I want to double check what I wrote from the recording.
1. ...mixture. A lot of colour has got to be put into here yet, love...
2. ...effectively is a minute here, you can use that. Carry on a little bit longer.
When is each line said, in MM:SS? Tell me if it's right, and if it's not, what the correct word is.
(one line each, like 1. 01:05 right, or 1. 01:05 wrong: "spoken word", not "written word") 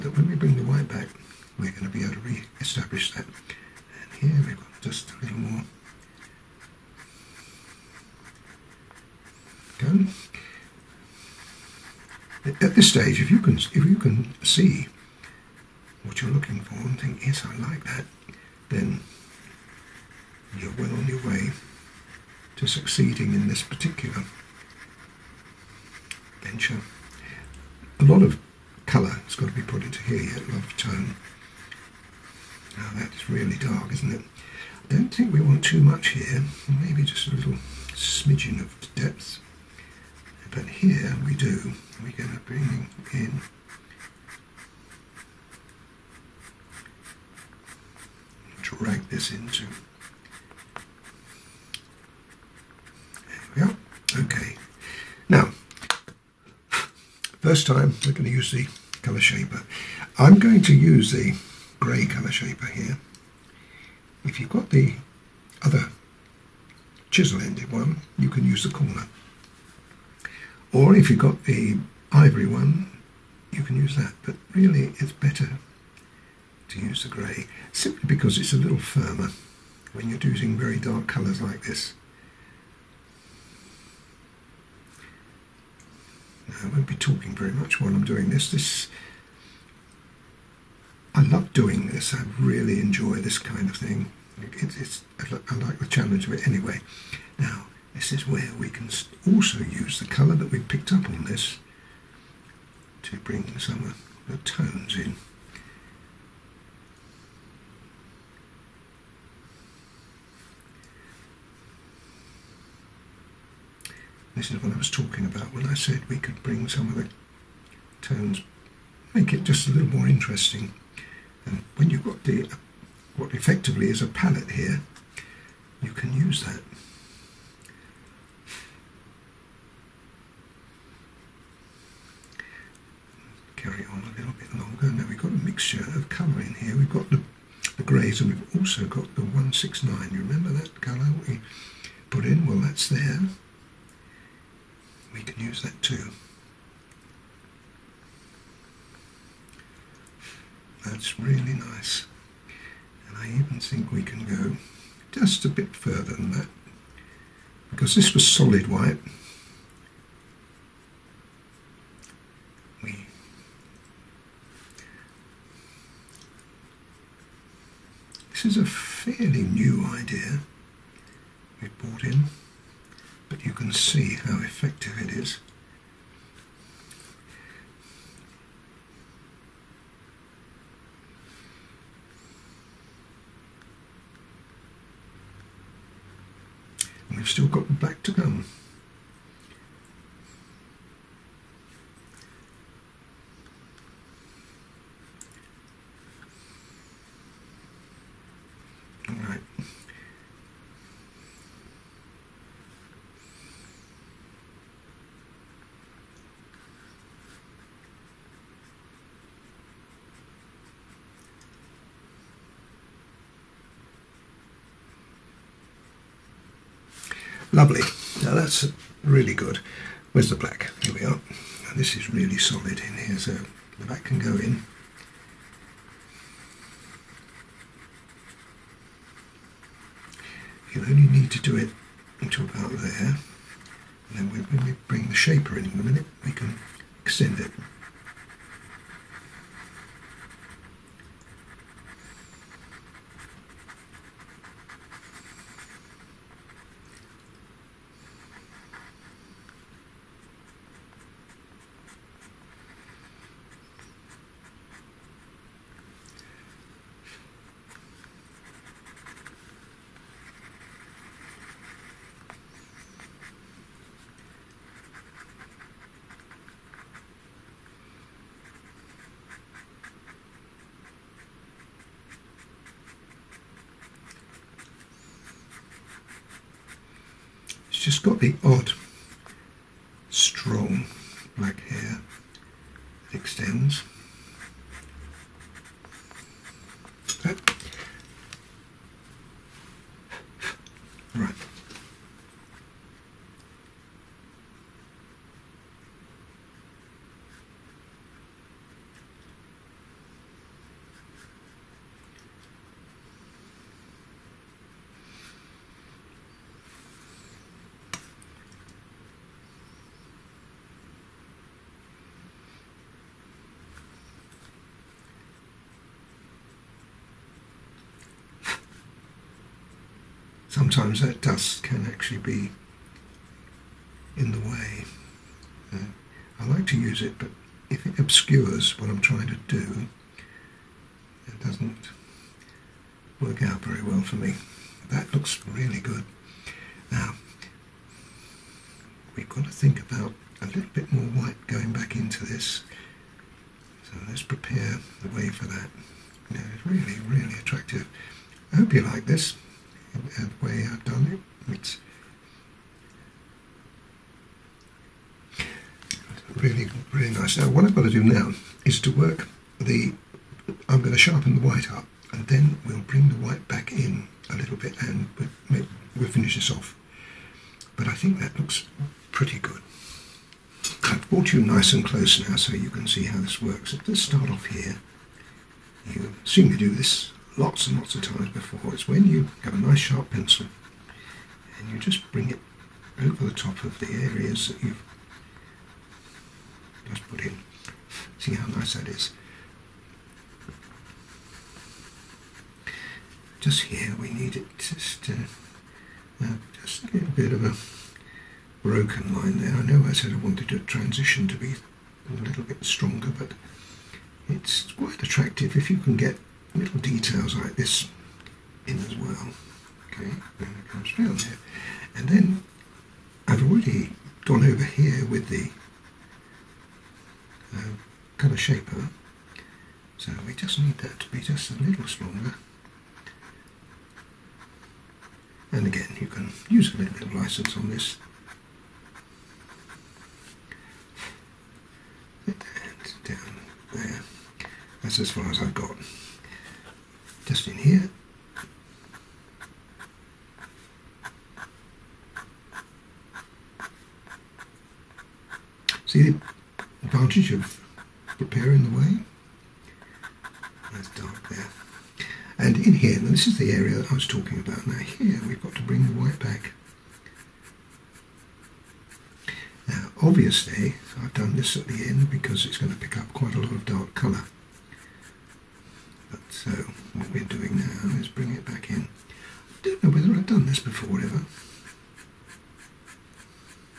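1. 00:26 wrong: "venture", not "mixture"
2. 02:03 wrong: "palette", not "minute".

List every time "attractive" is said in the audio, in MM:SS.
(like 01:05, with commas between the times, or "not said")
05:47, 06:45.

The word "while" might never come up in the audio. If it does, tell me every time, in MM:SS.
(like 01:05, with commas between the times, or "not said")
01:27.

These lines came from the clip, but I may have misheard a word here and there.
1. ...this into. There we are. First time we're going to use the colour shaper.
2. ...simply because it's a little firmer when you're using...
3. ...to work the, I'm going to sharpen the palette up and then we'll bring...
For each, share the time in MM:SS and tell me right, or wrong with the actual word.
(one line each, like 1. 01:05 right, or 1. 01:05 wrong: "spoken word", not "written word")
1. 00:49 right
2. 01:17 right
3. 05:58 wrong: "white", not "palette".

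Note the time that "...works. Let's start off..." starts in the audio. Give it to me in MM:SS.
06:13.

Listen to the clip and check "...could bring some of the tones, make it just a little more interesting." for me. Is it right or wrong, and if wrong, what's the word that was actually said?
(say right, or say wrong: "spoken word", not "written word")
right.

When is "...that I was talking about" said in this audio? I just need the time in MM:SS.
07:33.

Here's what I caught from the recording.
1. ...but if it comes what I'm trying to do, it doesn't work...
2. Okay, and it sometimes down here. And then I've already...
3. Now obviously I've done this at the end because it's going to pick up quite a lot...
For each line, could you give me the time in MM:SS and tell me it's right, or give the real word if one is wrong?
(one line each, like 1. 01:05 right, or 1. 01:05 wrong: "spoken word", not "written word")
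1. 05:27 wrong: "obscures", not "comes"
2. 06:49 wrong: "comes", not "sometimes"
3. 07:39 right.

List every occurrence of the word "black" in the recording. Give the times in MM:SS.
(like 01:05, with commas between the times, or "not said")
03:07, 03:40, 04:41.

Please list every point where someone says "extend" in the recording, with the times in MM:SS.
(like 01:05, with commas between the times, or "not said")
03:57, 04:43.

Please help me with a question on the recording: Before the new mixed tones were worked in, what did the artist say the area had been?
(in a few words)
solid white.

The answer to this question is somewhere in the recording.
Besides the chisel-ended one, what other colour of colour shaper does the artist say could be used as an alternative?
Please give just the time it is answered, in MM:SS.
01:12.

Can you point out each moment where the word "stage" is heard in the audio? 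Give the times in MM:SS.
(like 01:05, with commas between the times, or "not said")
00:12.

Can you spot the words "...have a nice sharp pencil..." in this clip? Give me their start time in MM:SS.
06:19.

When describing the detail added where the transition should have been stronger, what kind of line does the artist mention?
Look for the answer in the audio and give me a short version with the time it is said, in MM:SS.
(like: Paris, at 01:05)
broken line, at 06:38.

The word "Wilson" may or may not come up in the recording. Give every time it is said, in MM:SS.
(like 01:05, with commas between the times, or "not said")
not said.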